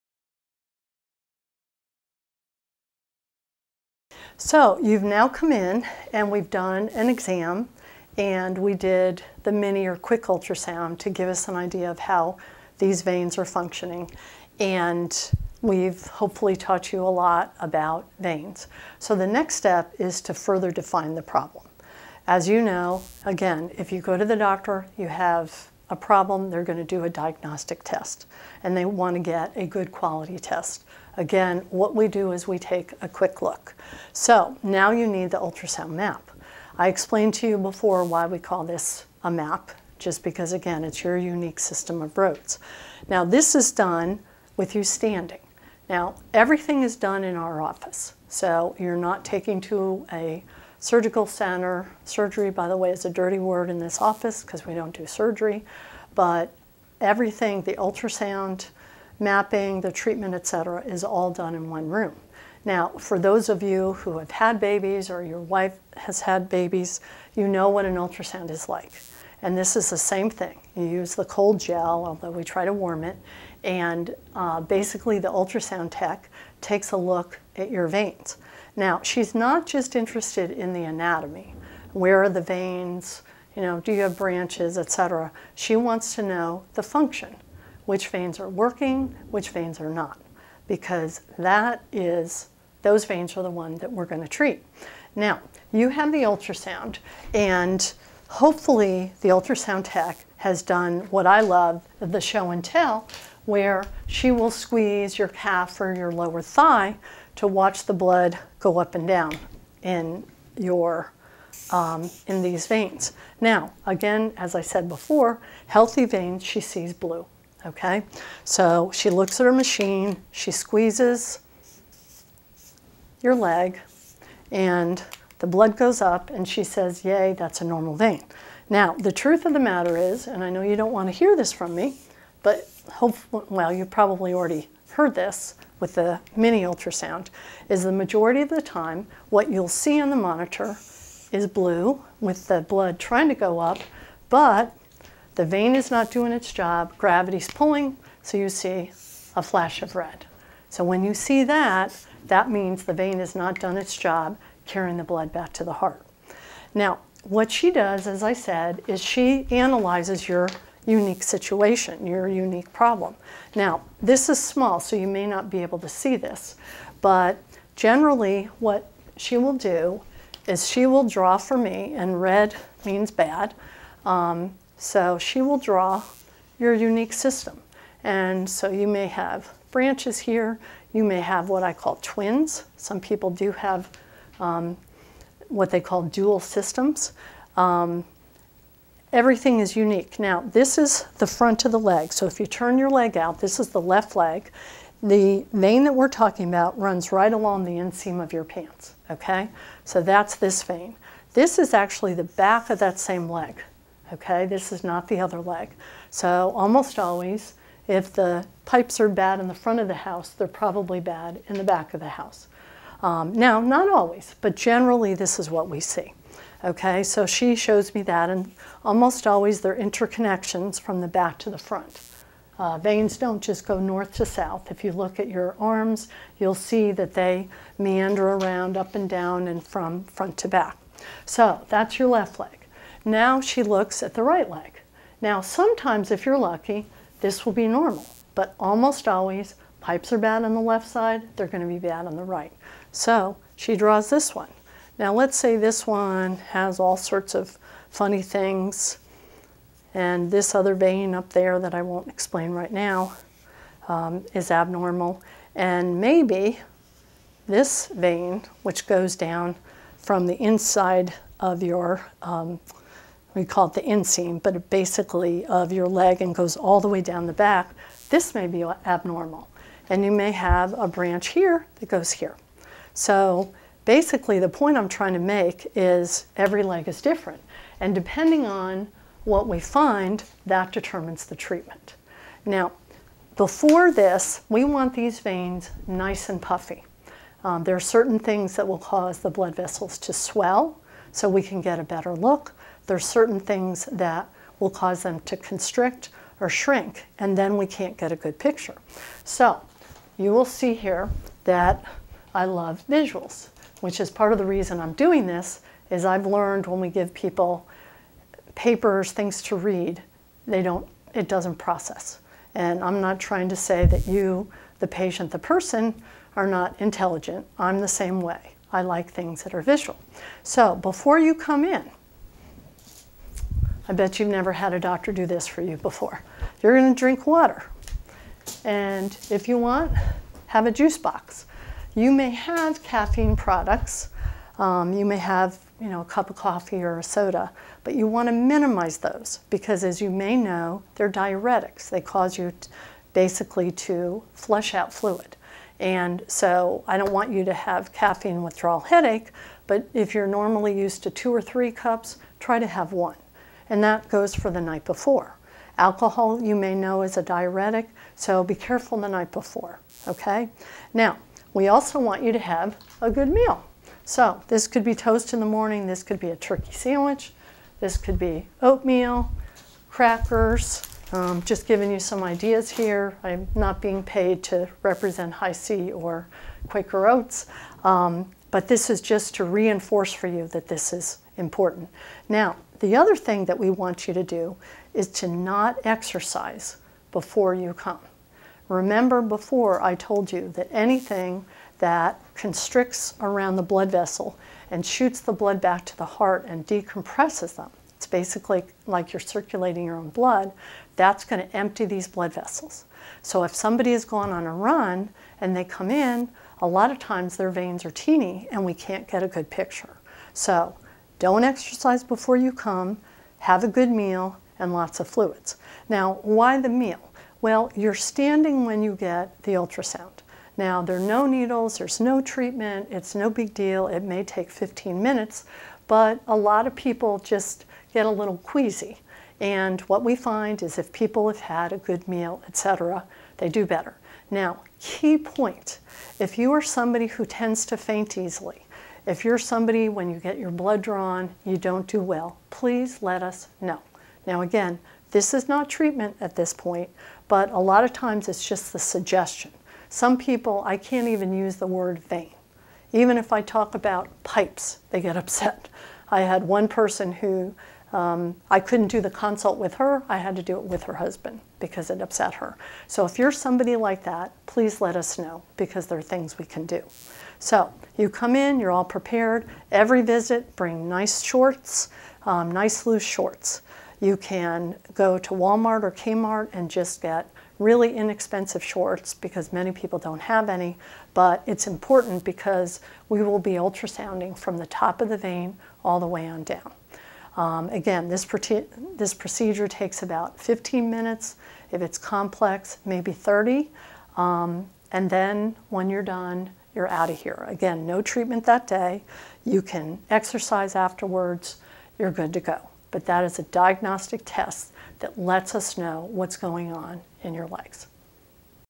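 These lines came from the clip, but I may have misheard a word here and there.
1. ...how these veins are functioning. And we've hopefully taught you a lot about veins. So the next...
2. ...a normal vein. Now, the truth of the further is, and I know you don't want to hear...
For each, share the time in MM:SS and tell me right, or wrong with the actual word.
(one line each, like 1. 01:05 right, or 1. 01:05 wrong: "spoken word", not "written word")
1. 00:11 right
2. 02:07 wrong: "matter", not "further".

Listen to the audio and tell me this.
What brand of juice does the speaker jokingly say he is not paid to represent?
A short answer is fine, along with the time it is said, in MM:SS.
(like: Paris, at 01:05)
Hi-C, at 06:15.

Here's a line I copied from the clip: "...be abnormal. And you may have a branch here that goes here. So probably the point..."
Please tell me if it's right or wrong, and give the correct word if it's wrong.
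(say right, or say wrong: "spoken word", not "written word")
wrong: "basically", not "probably".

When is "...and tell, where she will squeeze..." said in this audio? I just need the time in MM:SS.
01:42.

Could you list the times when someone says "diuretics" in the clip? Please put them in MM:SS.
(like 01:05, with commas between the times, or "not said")
05:41, 05:57.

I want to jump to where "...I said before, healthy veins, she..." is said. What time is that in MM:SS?
01:54.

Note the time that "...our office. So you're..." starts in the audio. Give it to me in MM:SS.
00:47.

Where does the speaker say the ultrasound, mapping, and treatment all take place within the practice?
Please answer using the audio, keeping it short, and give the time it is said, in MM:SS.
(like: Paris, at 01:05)
One room, at 01:01.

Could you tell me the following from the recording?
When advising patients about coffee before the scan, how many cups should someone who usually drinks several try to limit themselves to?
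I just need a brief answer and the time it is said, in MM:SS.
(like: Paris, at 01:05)
1, at 05:52.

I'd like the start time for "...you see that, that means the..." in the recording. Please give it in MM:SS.
02:31.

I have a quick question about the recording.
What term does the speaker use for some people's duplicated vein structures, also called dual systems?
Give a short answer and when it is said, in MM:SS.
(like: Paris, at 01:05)
Twins, at 03:02.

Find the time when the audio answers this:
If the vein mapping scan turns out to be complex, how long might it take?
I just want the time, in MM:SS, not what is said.
08:12.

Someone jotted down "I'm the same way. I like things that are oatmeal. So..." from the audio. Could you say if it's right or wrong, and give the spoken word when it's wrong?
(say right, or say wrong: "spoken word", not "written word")
wrong: "visual", not "oatmeal".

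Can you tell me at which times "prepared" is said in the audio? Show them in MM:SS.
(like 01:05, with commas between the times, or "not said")
07:48.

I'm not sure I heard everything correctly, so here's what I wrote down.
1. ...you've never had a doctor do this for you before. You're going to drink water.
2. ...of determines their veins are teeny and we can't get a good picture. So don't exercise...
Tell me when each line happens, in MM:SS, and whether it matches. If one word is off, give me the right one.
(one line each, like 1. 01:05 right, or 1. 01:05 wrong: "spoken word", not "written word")
1. 05:24 right
2. 06:46 wrong: "times", not "determines".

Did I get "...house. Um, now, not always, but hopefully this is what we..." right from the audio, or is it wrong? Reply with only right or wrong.
wrong.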